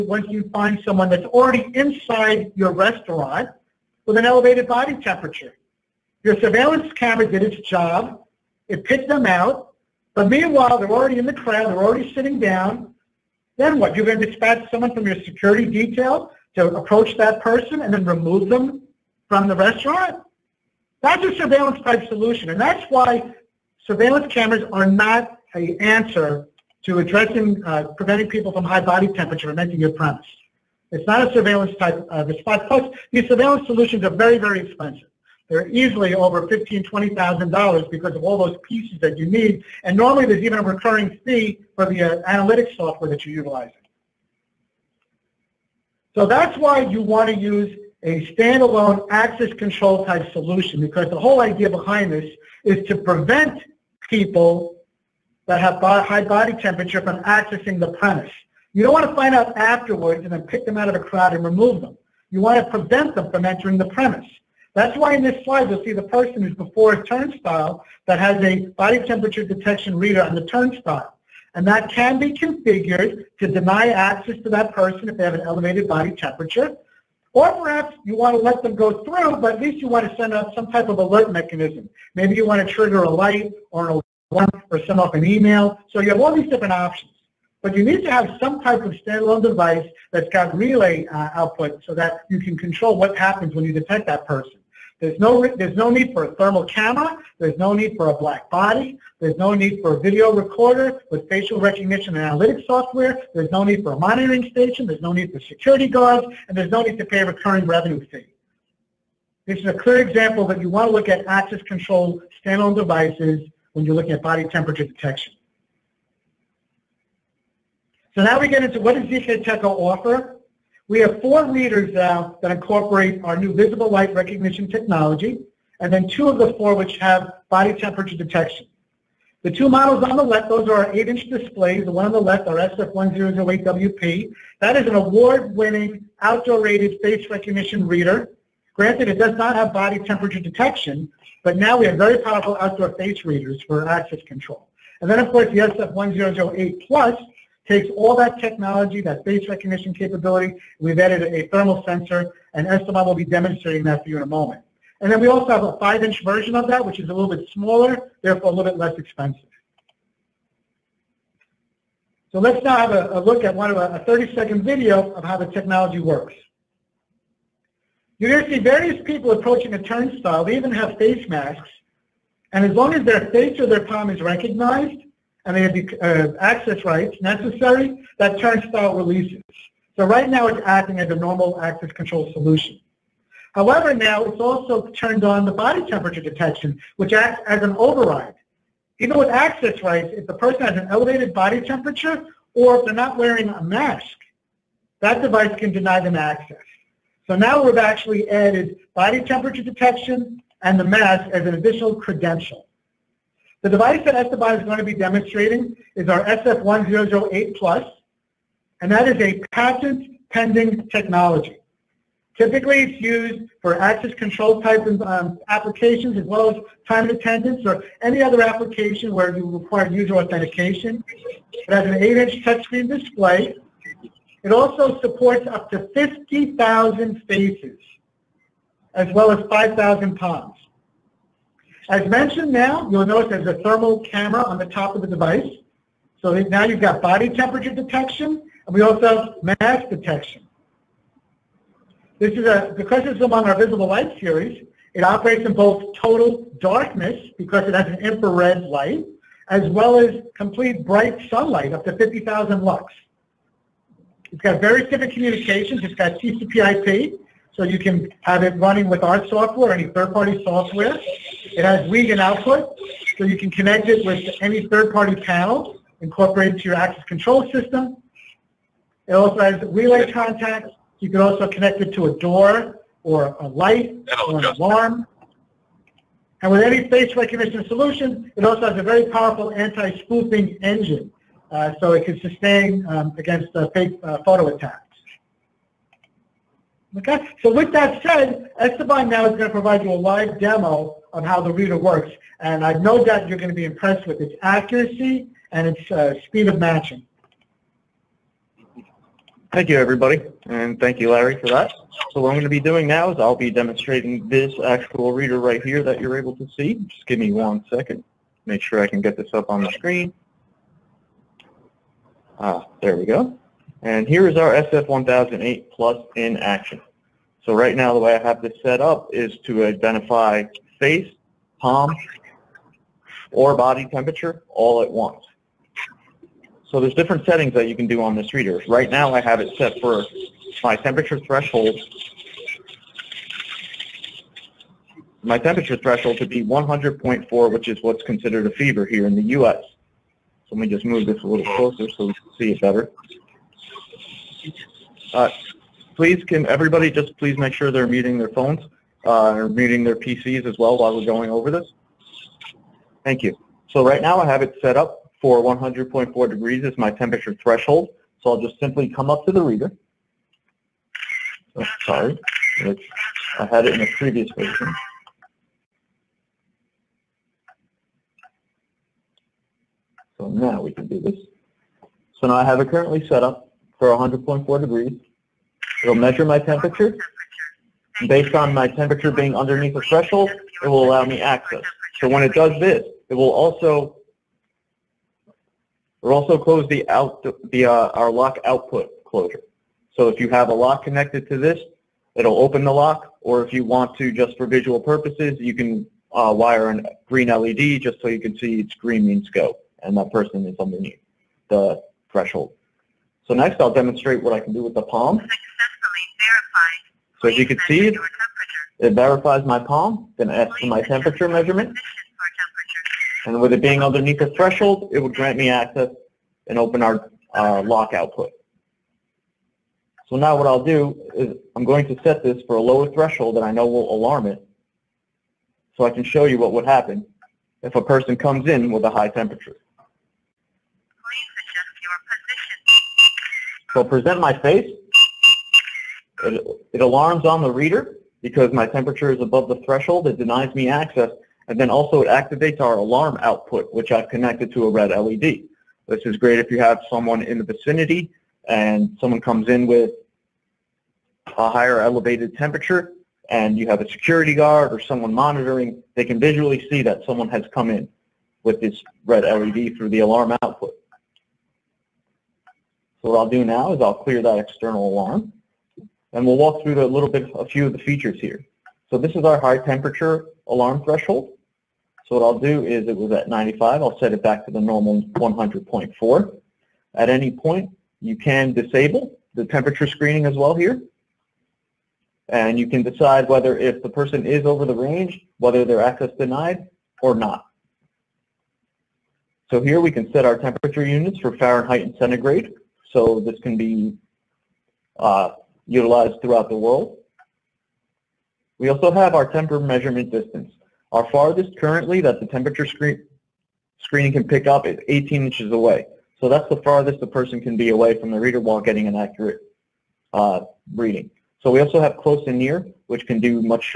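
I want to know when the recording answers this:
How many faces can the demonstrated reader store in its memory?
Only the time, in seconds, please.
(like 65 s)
225 s.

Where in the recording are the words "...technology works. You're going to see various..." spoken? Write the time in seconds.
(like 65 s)
165 s.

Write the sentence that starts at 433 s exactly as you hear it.
So I'll present my face it, it alarms on the reader because my temperature is above the threshold.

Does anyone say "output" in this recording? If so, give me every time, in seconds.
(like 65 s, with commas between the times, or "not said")
91 s, 262 s, 388 s, 417 s, 443 s, 460 s.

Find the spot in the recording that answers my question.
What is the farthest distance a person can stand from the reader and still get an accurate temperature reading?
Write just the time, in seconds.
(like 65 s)
504 s.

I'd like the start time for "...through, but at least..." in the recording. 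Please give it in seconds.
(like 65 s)
79 s.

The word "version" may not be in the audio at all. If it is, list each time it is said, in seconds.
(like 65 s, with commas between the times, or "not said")
156 s, 364 s.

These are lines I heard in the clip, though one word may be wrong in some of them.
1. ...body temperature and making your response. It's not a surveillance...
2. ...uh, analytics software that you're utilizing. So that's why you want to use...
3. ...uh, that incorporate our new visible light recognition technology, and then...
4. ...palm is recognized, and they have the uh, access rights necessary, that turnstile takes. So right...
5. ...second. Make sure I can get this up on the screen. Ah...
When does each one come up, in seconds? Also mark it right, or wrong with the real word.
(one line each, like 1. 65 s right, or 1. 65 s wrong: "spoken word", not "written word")
1. 28 s wrong: "premise", not "response"
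2. 42 s right
3. 122 s right
4. 173 s wrong: "releases", not "takes"
5. 307 s right.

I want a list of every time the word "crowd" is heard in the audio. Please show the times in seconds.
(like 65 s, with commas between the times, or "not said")
11 s, 60 s.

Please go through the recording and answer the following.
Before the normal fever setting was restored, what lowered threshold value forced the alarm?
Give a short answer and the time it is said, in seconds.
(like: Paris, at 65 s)
95, at 473 s.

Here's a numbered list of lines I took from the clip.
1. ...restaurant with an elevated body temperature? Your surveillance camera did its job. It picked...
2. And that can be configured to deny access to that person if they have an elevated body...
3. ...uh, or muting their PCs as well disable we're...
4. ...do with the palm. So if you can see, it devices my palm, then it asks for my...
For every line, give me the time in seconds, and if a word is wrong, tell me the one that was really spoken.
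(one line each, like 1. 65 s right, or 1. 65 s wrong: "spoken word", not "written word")
1. 2 s right
2. 71 s right
3. 349 s wrong: "while", not "disable"
4. 404 s wrong: "verifies", not "devices".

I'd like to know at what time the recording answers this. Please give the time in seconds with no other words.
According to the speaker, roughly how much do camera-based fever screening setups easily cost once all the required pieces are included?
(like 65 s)
36 s.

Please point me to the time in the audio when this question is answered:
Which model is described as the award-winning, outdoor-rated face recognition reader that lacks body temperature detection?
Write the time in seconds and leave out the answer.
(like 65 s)
132 s.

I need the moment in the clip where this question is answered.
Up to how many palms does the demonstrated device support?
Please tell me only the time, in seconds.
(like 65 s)
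229 s.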